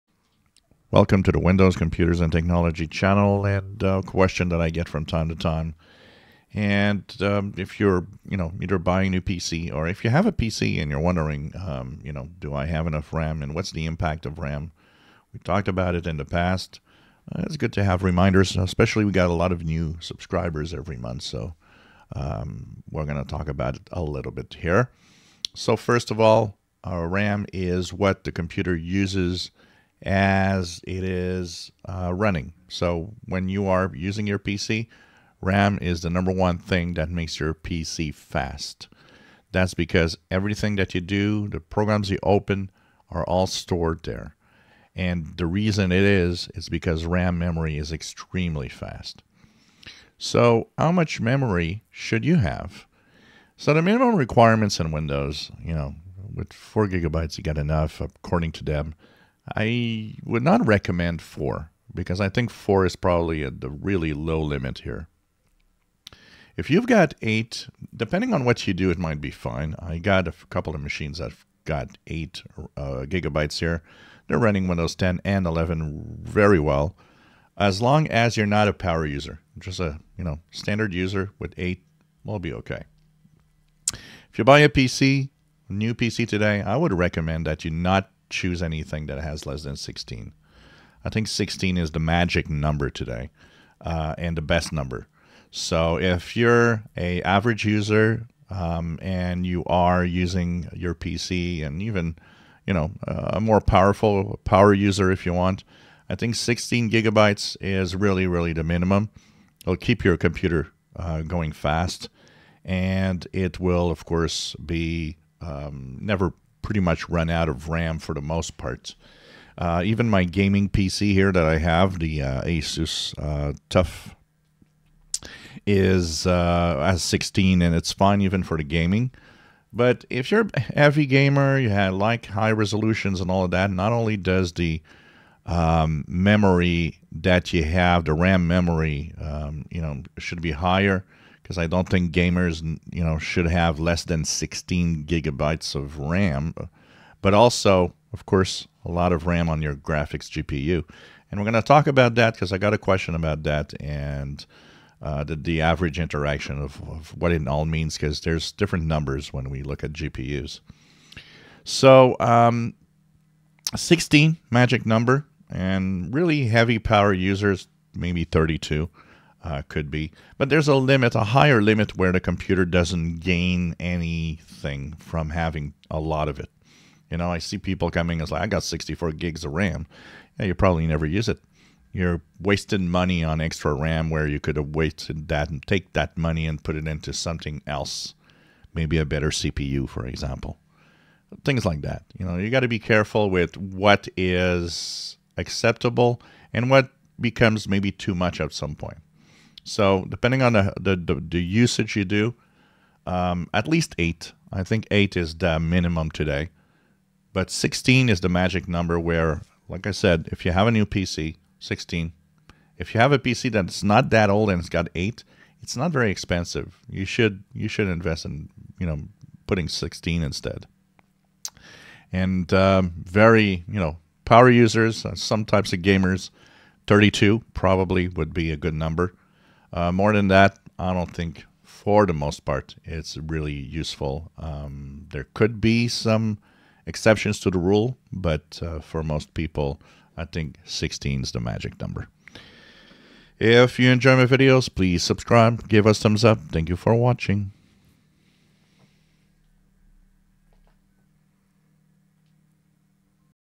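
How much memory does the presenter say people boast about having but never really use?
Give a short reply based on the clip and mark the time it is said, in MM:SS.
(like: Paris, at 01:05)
64 GB, at 02:58.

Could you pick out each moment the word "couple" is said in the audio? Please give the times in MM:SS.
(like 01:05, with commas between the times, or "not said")
01:10.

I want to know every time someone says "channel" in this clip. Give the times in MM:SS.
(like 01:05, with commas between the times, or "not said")
00:02.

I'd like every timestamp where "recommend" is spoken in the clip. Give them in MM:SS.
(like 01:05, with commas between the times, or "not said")
01:00, 01:26.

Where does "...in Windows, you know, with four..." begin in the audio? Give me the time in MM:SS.
00:54.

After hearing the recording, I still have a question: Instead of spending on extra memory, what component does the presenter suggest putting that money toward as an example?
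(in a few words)
a better CPU.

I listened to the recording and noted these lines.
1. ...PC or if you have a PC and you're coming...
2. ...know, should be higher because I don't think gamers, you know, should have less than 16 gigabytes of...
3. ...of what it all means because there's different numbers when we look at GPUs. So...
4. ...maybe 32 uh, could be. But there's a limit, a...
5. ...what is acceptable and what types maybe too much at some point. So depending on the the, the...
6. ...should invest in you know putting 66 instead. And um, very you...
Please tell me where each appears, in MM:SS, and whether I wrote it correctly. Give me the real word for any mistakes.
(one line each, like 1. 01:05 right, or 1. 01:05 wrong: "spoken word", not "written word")
1. 00:09 wrong: "wondering", not "coming"
2. 02:19 right
3. 02:36 right
4. 02:47 right
5. 03:13 wrong: "becomes", not "types"
6. 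03:37 wrong: "16", not "66".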